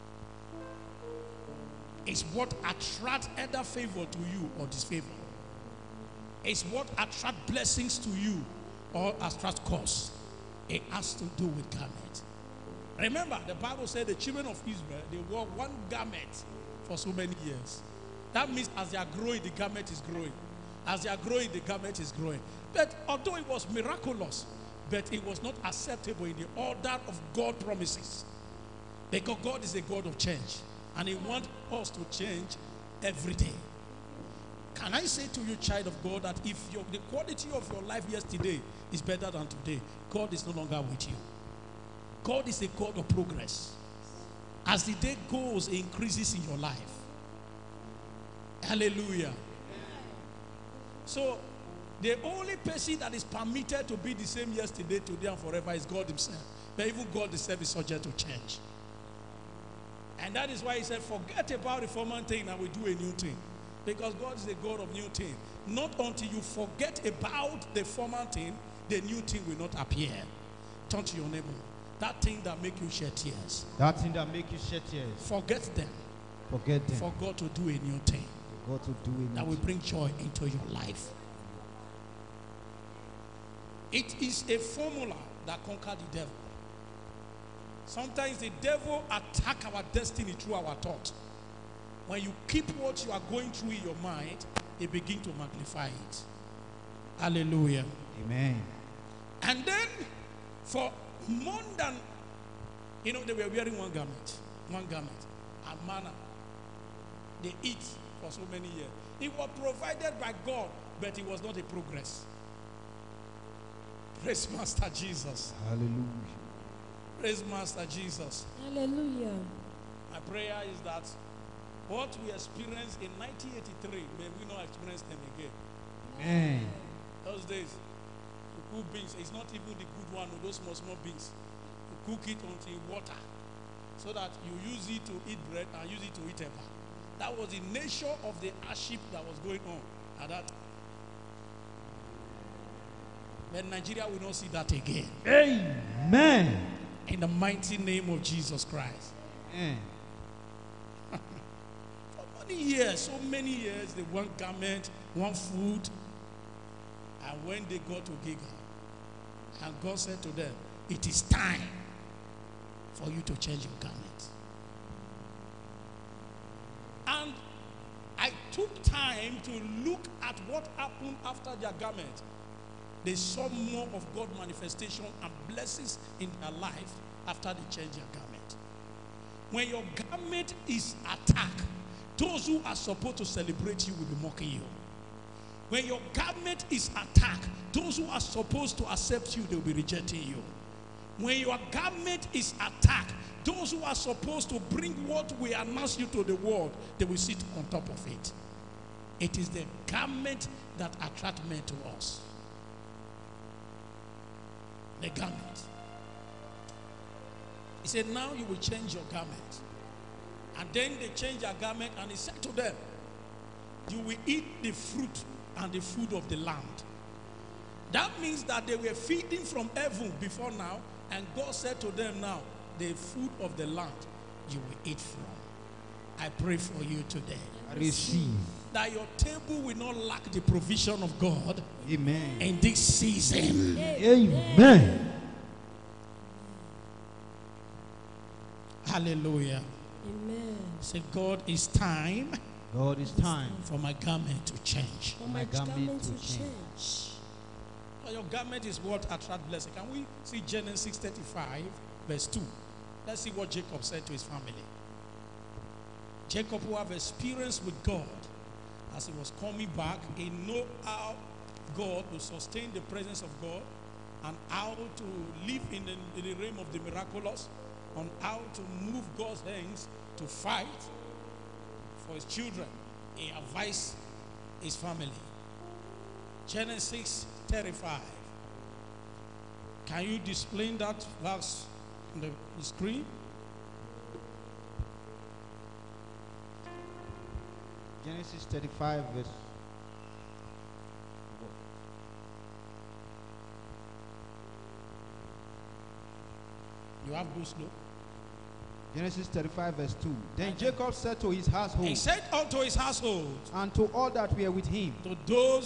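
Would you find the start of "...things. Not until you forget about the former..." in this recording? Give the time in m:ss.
1:05.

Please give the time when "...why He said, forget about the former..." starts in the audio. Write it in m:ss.
1:00.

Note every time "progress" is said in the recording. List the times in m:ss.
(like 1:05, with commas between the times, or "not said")
0:43, 1:51.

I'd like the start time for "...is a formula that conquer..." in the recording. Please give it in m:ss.
1:24.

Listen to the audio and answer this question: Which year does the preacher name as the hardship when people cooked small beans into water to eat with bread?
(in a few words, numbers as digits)
1983.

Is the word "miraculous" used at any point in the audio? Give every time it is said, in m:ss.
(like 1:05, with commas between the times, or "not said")
0:23, 4:26.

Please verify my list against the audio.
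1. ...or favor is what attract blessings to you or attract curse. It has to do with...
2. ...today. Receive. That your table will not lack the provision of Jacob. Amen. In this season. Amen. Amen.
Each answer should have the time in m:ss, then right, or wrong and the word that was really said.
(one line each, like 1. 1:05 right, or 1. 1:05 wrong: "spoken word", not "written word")
1. 0:04 wrong: "disfavor", not "favor"
2. 3:47 wrong: "God", not "Jacob".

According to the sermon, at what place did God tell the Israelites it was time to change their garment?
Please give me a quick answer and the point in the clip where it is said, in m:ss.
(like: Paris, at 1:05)
Giga, at 2:38.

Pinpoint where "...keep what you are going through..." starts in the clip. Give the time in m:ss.
1:32.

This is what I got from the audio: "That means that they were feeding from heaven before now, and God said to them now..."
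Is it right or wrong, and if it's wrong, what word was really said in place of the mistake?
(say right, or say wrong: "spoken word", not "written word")
right.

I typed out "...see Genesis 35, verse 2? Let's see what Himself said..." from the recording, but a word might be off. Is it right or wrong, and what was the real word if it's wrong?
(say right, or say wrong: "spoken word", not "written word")
wrong: "Jacob", not "Himself".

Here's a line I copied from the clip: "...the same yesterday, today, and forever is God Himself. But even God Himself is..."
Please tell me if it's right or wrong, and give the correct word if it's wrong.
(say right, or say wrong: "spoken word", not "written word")
right.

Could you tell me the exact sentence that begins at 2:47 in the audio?
And I took time to look at what happened after their garment.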